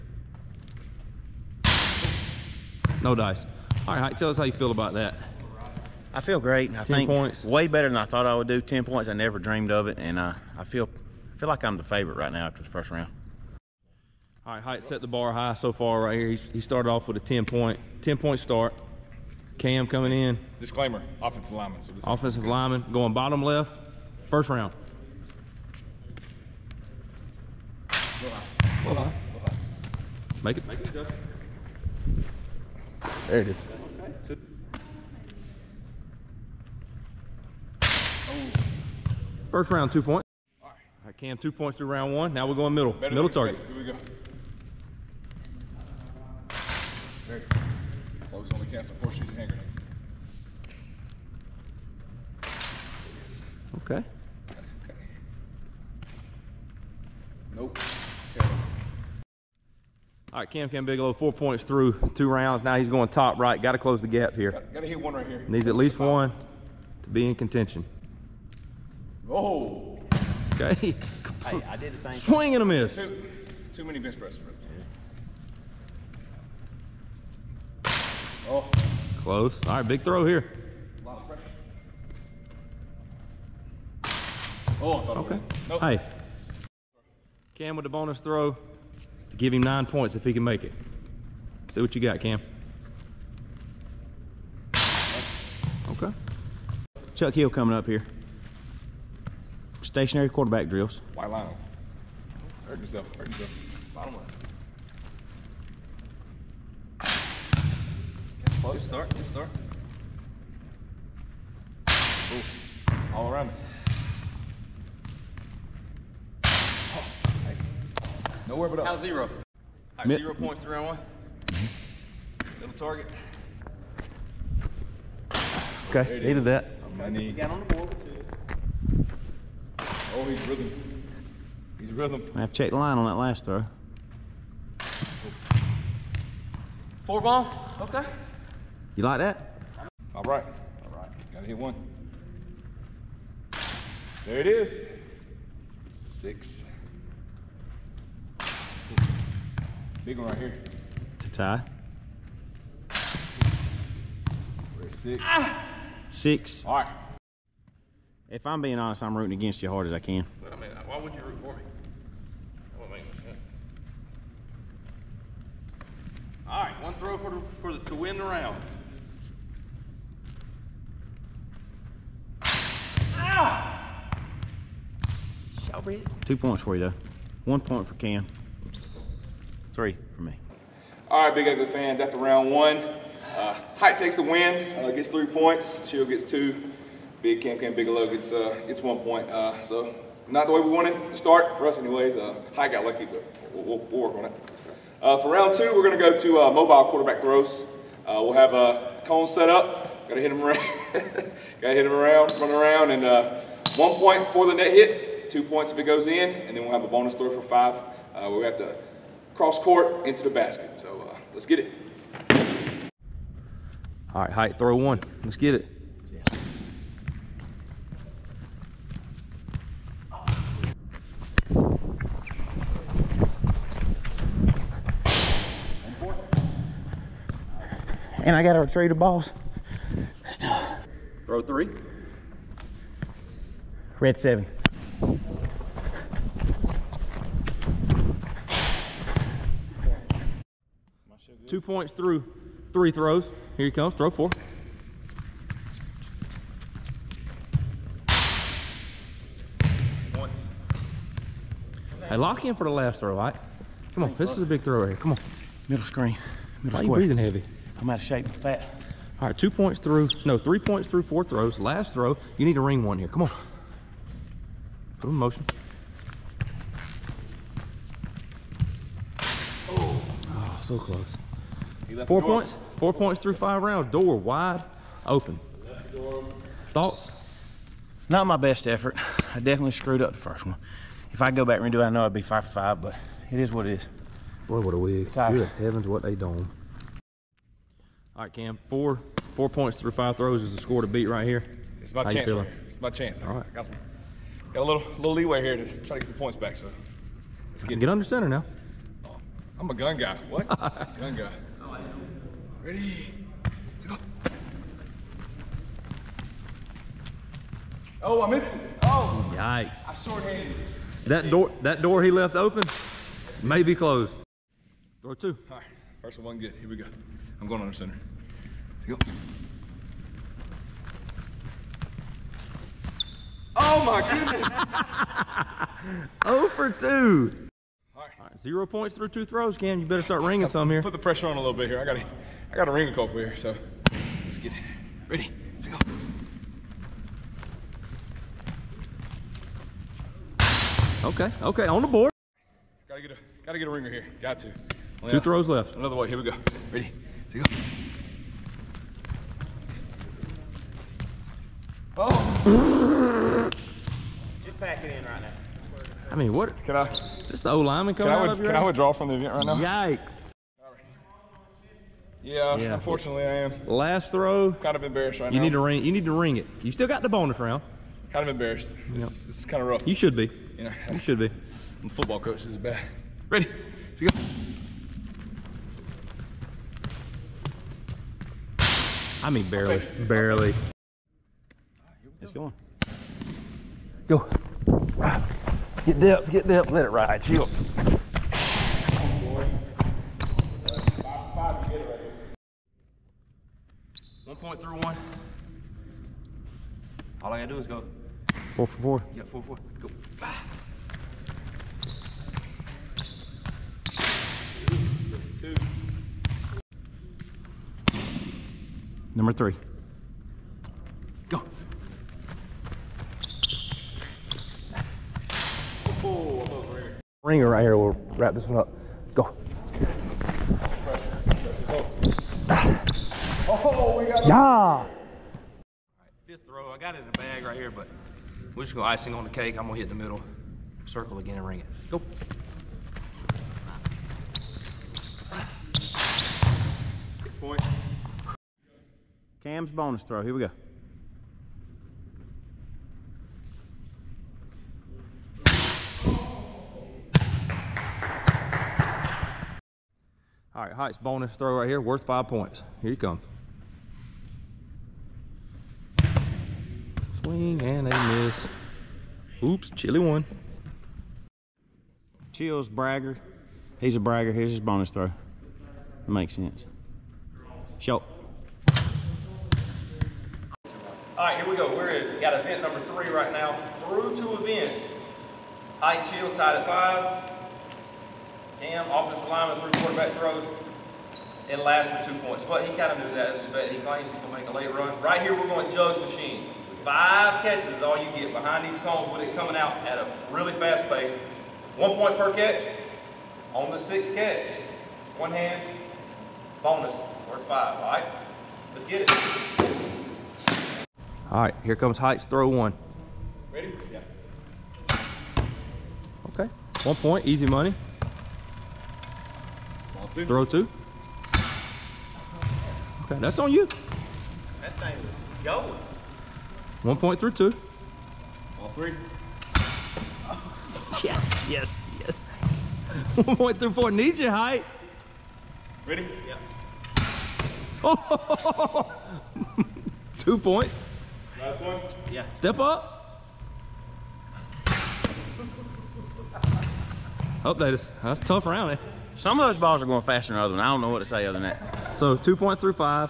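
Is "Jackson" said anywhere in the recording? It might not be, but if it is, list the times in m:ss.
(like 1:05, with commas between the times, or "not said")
not said.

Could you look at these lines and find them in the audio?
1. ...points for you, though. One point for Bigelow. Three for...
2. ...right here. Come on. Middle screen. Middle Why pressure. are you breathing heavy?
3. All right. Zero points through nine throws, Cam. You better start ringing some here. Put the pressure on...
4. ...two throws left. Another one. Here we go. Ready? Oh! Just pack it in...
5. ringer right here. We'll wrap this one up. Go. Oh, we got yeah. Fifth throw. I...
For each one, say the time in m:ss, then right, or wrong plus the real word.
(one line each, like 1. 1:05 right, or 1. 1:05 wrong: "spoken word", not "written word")
1. 2:56 wrong: "Cam", not "Bigelow"
2. 4:14 wrong: "square", not "pressure"
3. 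5:27 wrong: "two", not "nine"
4. 5:45 right
5. 6:57 right.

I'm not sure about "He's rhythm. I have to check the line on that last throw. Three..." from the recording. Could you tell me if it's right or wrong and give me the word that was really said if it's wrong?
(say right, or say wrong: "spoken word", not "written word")
wrong: "Four", not "Three".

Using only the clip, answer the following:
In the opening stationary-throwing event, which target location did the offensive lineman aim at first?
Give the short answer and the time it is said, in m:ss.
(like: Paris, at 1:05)
Bottom left, at 0:23.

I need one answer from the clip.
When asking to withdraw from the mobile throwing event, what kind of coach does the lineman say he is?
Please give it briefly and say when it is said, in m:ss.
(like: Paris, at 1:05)
Football coach, at 6:11.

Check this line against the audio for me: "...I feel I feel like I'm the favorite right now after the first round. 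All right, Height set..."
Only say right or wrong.
right.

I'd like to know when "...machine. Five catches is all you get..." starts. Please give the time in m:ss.
8:06.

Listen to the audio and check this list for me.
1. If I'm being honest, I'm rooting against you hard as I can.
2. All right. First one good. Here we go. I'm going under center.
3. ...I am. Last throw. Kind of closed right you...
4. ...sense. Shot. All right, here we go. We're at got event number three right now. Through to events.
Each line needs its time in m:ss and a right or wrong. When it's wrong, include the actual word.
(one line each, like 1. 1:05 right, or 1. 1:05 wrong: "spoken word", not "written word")
1. 2:38 right
2. 5:15 right
3. 6:03 wrong: "embarrassed", not "closed"
4. 7:46 right.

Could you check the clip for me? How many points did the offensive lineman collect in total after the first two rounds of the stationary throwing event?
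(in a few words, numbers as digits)
4.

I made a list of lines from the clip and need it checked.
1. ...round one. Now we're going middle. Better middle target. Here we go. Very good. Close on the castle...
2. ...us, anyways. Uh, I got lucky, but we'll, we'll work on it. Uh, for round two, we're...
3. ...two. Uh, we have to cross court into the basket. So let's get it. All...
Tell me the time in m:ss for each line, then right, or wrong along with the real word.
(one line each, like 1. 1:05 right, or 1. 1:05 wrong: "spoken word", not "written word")
1. 0:41 right
2. 3:11 right
3. 3:27 wrong: "five", not "two".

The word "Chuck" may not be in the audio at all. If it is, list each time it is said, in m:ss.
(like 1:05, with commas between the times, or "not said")
1:37.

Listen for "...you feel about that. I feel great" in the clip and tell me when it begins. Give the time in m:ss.
0:04.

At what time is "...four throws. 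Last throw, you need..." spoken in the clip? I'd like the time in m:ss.
4:21.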